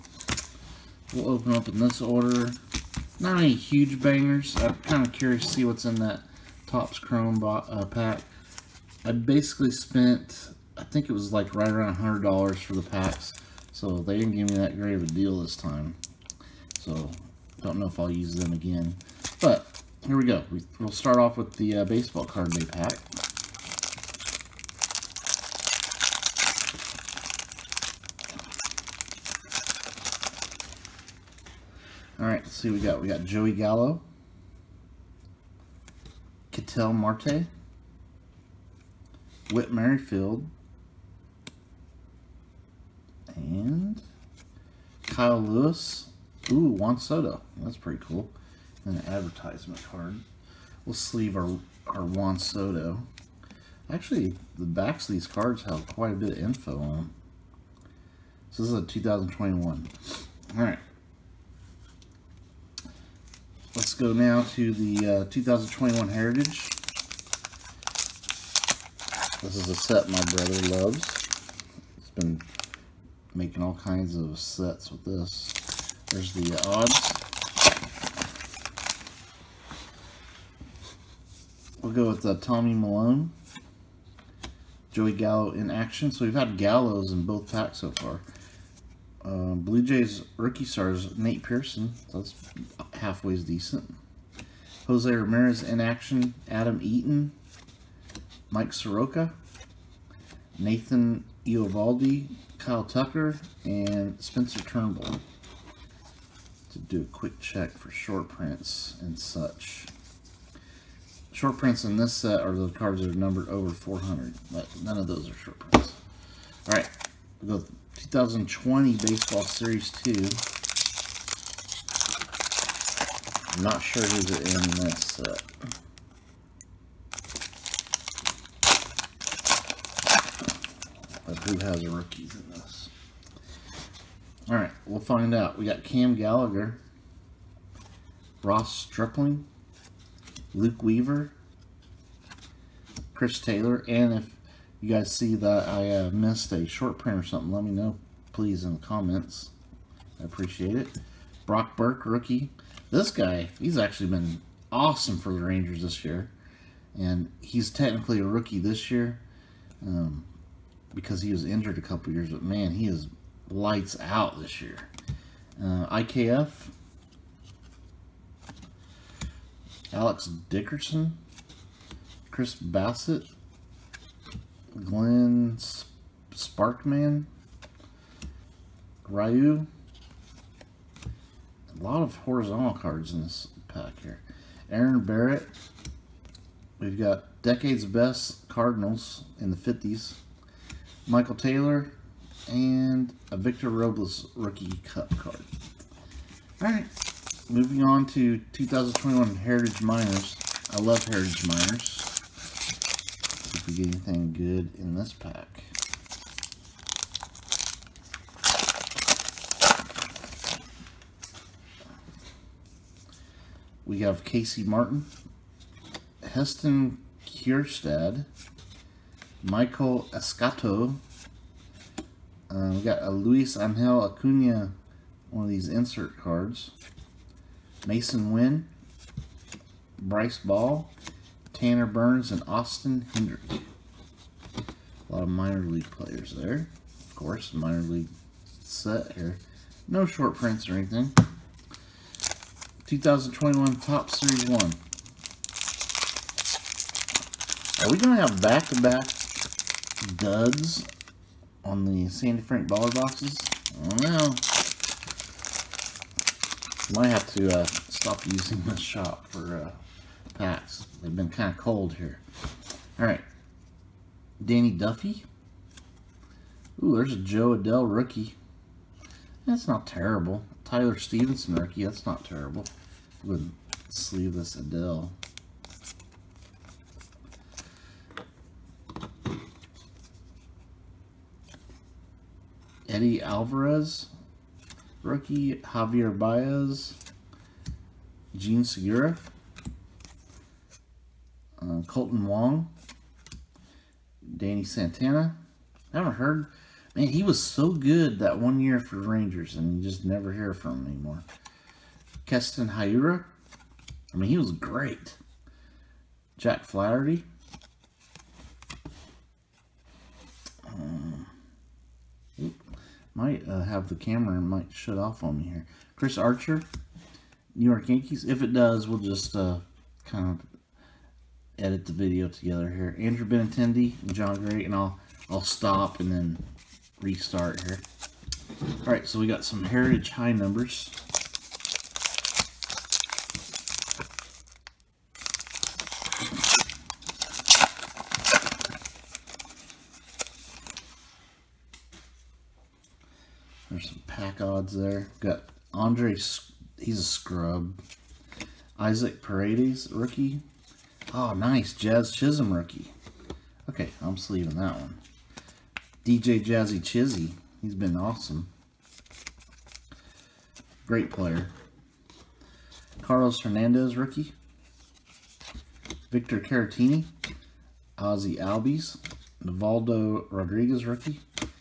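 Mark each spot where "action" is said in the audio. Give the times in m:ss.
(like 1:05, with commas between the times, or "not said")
1:25, 1:35.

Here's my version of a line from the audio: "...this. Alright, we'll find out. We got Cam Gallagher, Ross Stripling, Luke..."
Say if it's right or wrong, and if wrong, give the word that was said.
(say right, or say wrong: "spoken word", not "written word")
right.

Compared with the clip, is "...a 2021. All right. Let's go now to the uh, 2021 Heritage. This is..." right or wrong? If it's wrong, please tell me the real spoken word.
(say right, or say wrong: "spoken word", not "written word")
right.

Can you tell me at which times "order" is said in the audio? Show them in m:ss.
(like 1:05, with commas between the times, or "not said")
0:02.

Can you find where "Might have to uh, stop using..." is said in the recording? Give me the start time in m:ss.
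4:17.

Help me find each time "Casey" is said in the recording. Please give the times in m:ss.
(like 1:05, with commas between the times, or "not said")
3:34.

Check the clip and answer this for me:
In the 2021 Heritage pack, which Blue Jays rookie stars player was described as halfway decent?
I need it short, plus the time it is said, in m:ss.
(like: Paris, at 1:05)
Nate Pearson, at 1:31.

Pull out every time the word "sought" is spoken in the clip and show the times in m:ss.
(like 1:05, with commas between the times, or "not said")
not said.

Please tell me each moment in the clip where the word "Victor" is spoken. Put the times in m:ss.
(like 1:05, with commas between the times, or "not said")
3:13, 6:06.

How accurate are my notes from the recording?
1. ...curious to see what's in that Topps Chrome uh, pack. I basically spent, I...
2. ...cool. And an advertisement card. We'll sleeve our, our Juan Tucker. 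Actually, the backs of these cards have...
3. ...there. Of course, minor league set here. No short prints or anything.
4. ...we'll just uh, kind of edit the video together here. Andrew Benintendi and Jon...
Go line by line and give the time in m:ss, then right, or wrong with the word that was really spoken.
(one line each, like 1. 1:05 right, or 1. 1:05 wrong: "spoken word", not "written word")
1. 0:05 right
2. 0:48 wrong: "Soto", not "Tucker"
3. 3:56 right
4. 5:18 right.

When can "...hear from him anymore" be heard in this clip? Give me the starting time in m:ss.
5:00.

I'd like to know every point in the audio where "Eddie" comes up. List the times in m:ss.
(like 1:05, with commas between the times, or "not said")
4:42.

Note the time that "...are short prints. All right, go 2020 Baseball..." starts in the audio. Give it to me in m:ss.
1:55.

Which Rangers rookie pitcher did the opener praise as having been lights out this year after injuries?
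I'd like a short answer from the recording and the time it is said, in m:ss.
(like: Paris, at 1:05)
Brock Burke, at 2:31.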